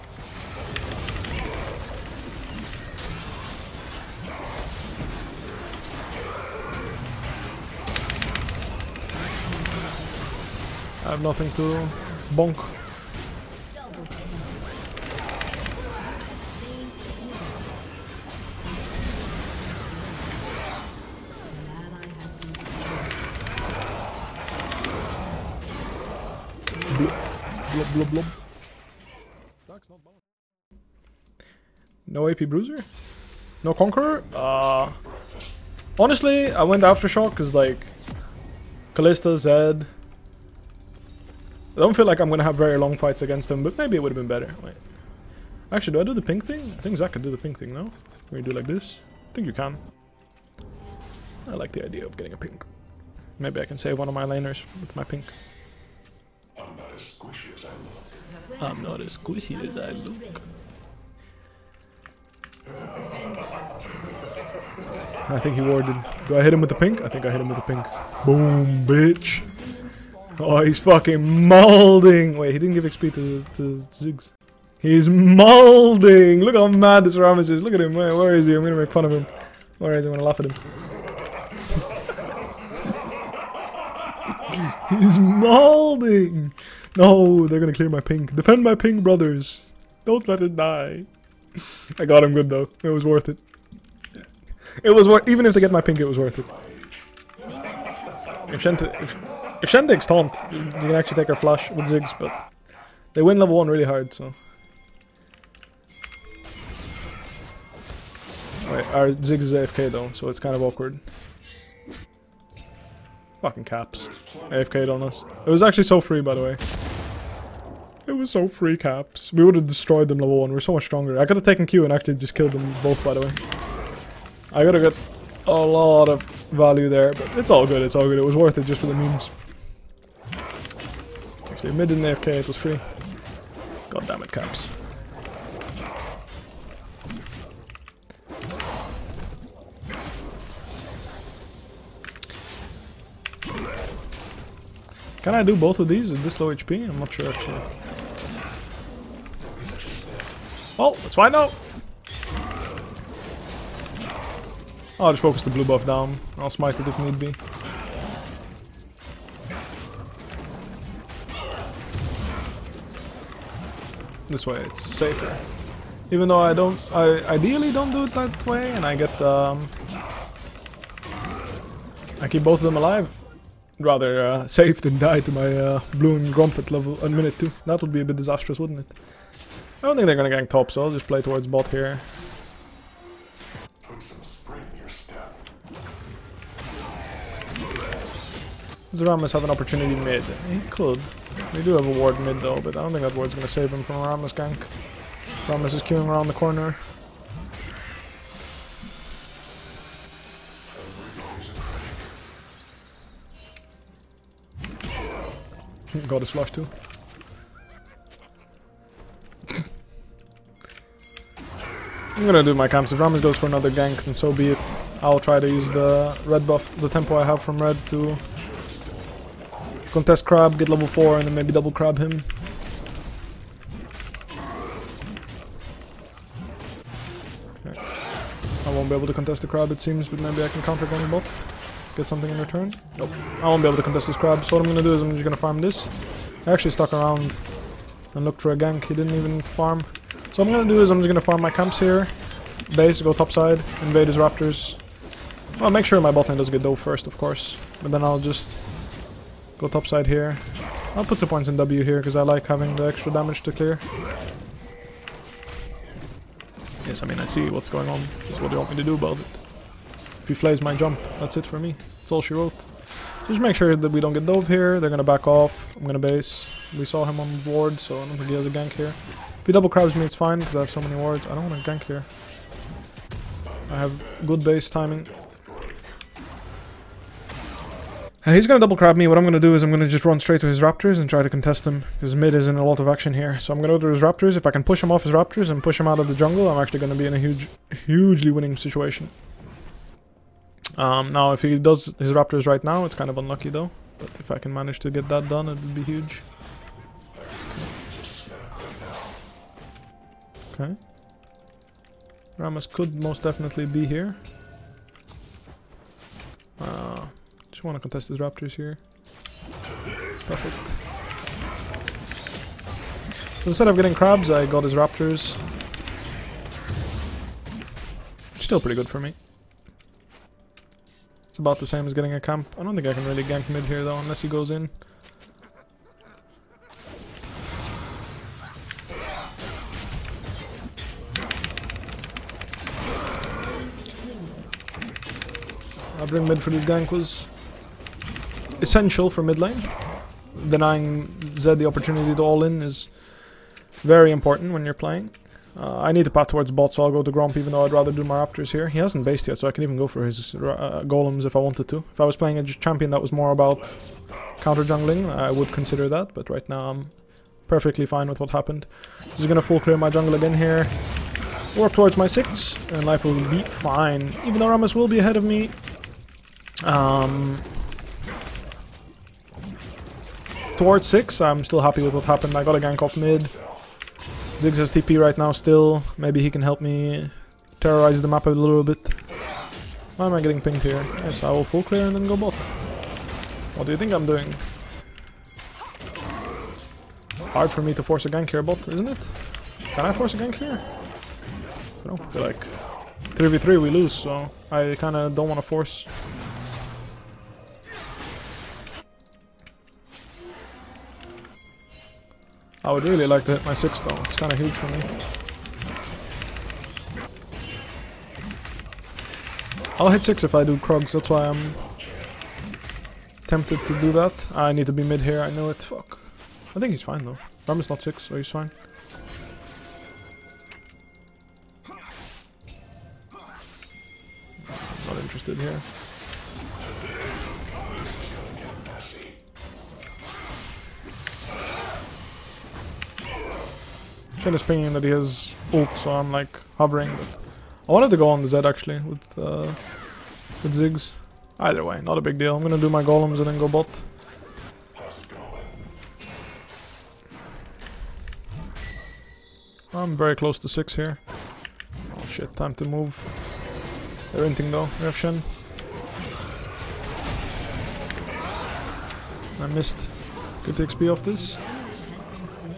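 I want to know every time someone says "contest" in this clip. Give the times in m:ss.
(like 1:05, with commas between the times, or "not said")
3:39, 3:49, 3:53, 4:41, 5:07.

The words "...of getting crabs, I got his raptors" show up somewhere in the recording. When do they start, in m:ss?
5:13.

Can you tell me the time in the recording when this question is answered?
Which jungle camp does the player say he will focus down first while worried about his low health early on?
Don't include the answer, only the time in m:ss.
2:35.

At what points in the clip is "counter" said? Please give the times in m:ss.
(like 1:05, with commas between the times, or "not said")
3:50, 5:54.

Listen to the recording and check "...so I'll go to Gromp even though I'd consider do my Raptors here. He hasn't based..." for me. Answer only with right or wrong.
wrong.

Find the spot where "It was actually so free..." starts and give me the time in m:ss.
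1:55.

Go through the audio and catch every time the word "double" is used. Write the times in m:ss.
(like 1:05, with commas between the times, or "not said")
3:41, 4:29, 4:38.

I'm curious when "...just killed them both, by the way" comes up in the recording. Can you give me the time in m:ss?
2:02.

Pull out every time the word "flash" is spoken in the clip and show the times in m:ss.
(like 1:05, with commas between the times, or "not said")
1:41, 3:26.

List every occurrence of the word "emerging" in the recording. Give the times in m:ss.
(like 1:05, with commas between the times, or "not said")
not said.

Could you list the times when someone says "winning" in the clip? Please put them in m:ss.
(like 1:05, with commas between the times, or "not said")
4:48.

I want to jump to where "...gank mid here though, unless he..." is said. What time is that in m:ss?
5:23.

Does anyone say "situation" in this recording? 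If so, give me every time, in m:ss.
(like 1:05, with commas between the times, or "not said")
4:48.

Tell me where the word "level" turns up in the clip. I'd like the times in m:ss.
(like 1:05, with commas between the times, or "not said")
1:43, 2:00, 2:56, 3:40.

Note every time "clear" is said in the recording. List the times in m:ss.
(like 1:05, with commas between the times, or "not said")
1:27, 4:13, 5:59, 6:21.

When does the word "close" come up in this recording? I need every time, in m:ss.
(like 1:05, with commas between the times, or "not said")
7:30.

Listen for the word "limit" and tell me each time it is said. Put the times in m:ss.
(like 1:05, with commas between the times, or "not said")
not said.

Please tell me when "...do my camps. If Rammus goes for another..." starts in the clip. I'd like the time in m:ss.
3:32.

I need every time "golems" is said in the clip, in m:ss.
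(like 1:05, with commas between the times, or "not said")
5:50, 7:22.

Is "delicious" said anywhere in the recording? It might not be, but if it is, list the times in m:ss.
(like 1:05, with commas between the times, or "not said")
not said.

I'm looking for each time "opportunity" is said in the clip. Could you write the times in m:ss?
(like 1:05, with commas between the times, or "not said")
3:09, 5:41.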